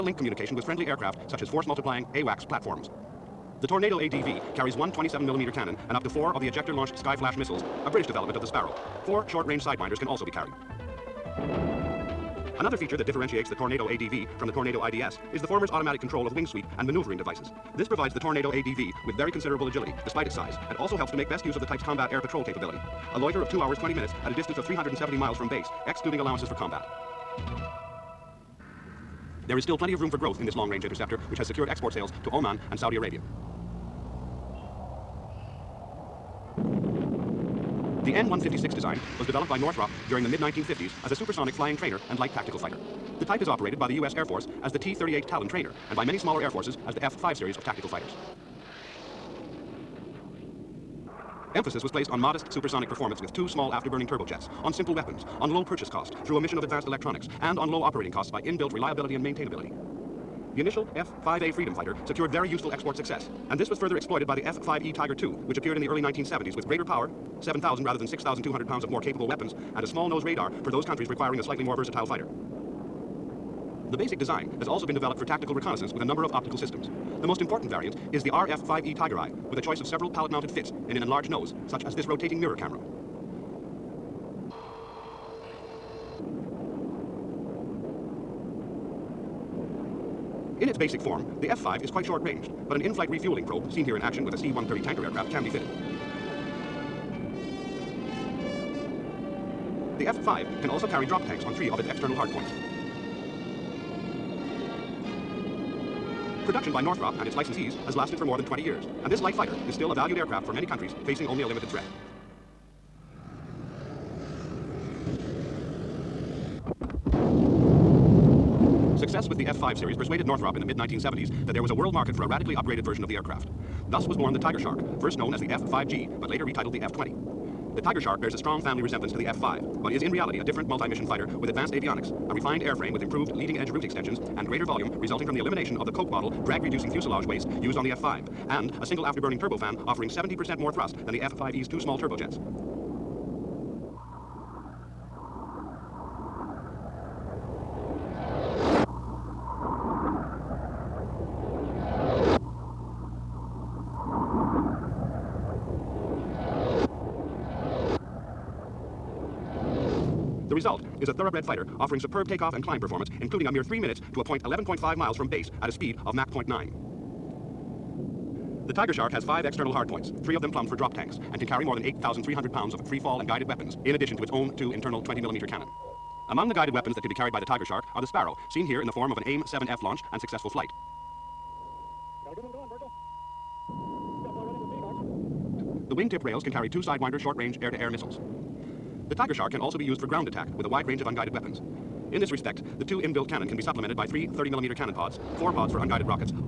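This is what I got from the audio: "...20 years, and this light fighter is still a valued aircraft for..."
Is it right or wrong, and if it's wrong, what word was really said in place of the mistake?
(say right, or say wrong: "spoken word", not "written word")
right.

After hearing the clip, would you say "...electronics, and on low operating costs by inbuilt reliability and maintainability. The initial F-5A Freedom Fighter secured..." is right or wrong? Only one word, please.
right.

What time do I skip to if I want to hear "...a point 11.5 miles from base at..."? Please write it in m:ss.
2:44.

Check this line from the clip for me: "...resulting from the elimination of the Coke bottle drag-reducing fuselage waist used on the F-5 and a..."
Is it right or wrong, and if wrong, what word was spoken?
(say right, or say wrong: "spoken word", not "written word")
right.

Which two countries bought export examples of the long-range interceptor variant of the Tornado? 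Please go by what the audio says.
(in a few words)
Oman and Saudi Arabia.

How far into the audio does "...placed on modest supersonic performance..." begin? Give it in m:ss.
0:51.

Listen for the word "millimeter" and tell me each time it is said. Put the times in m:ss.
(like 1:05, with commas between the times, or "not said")
0:05, 2:55, 3:14.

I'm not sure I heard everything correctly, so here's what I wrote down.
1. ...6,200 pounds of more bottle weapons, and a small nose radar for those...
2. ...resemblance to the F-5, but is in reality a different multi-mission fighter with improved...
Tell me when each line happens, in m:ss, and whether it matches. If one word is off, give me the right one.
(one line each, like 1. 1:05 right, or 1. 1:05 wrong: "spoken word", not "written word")
1. 1:08 wrong: "capable", not "bottle"
2. 2:08 wrong: "advanced", not "improved".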